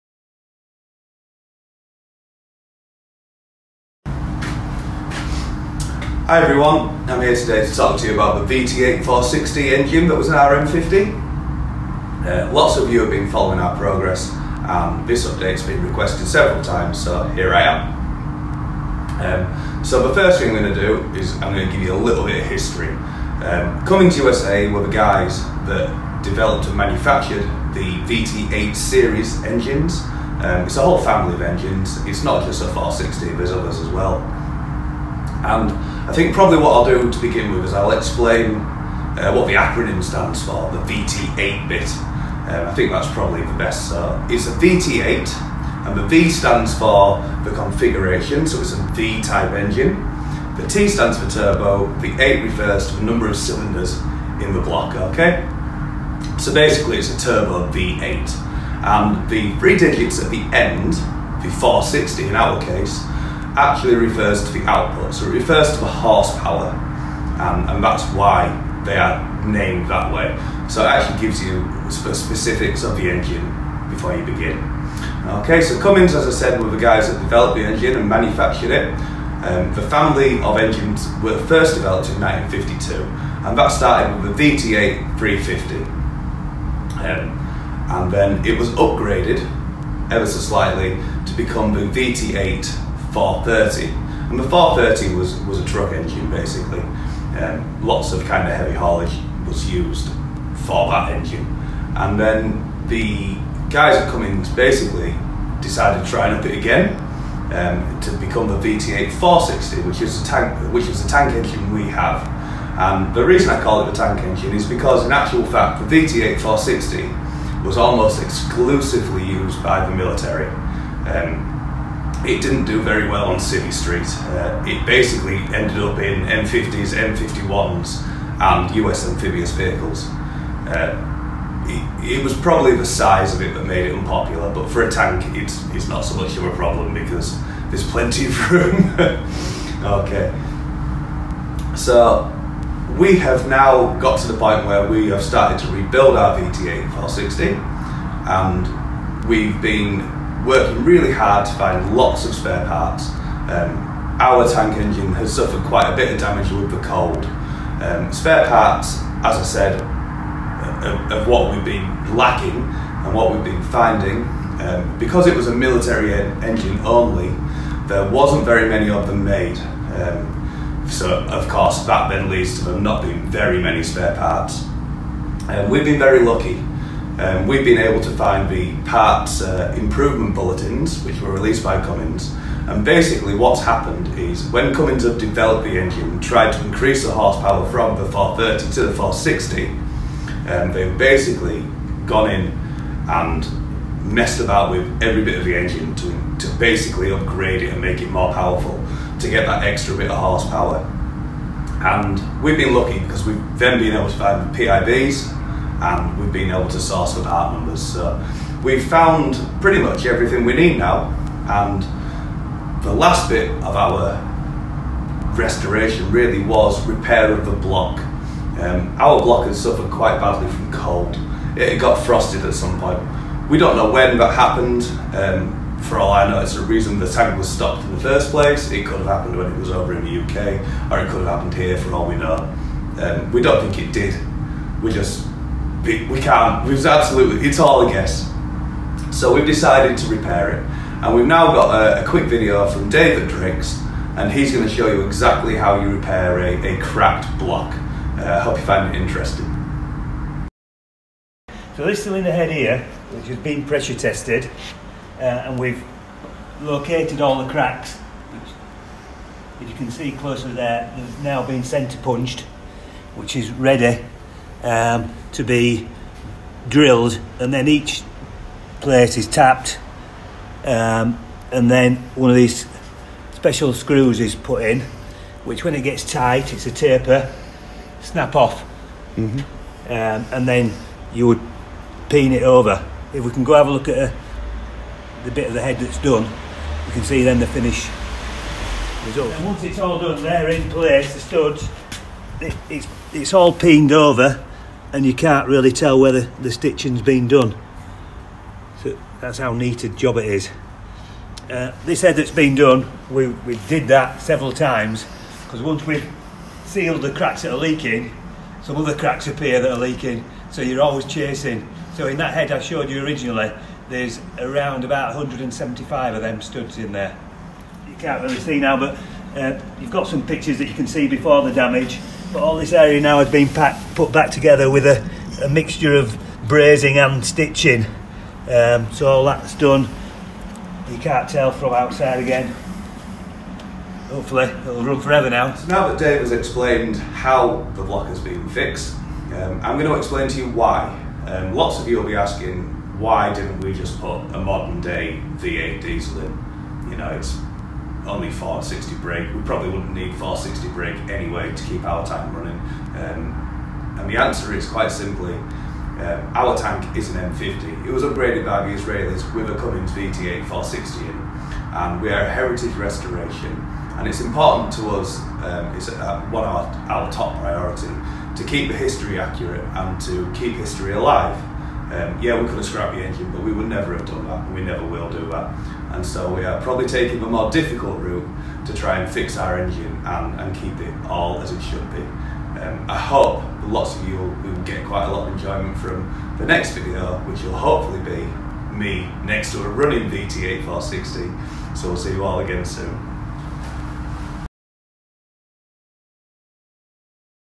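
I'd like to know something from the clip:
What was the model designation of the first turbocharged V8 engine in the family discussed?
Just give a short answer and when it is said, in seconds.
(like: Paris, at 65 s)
VT8 350, at 84 s.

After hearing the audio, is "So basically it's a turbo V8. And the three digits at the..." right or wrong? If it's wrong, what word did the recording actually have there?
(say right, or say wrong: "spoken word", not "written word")
right.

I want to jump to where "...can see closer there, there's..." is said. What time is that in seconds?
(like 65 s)
259 s.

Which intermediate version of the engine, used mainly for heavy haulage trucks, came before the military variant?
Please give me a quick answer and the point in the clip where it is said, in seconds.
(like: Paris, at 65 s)
VT8 430, at 91 s.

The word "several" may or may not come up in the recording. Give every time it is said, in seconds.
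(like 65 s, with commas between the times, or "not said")
16 s, 304 s.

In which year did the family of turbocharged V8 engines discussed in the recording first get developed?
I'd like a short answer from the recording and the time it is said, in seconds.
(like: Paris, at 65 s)
1952, at 82 s.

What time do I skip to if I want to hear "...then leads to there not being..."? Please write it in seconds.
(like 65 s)
172 s.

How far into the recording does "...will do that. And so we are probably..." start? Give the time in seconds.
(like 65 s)
374 s.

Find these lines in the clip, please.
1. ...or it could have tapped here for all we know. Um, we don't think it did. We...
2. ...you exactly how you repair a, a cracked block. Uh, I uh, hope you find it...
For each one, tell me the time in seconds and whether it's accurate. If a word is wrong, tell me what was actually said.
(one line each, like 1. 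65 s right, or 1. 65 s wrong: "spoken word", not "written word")
1. 230 s wrong: "happened", not "tapped"
2. 244 s right.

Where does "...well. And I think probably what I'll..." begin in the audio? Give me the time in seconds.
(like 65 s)
33 s.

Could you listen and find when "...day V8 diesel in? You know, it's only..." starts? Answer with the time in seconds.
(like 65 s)
344 s.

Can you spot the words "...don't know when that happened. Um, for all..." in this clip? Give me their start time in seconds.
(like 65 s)
223 s.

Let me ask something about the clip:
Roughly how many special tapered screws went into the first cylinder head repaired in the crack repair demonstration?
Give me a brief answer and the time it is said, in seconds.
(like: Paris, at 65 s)
175, at 315 s.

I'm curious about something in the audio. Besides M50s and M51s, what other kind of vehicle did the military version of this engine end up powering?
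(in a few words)
US amphibious vehicles.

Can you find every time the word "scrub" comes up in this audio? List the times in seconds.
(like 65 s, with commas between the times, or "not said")
not said.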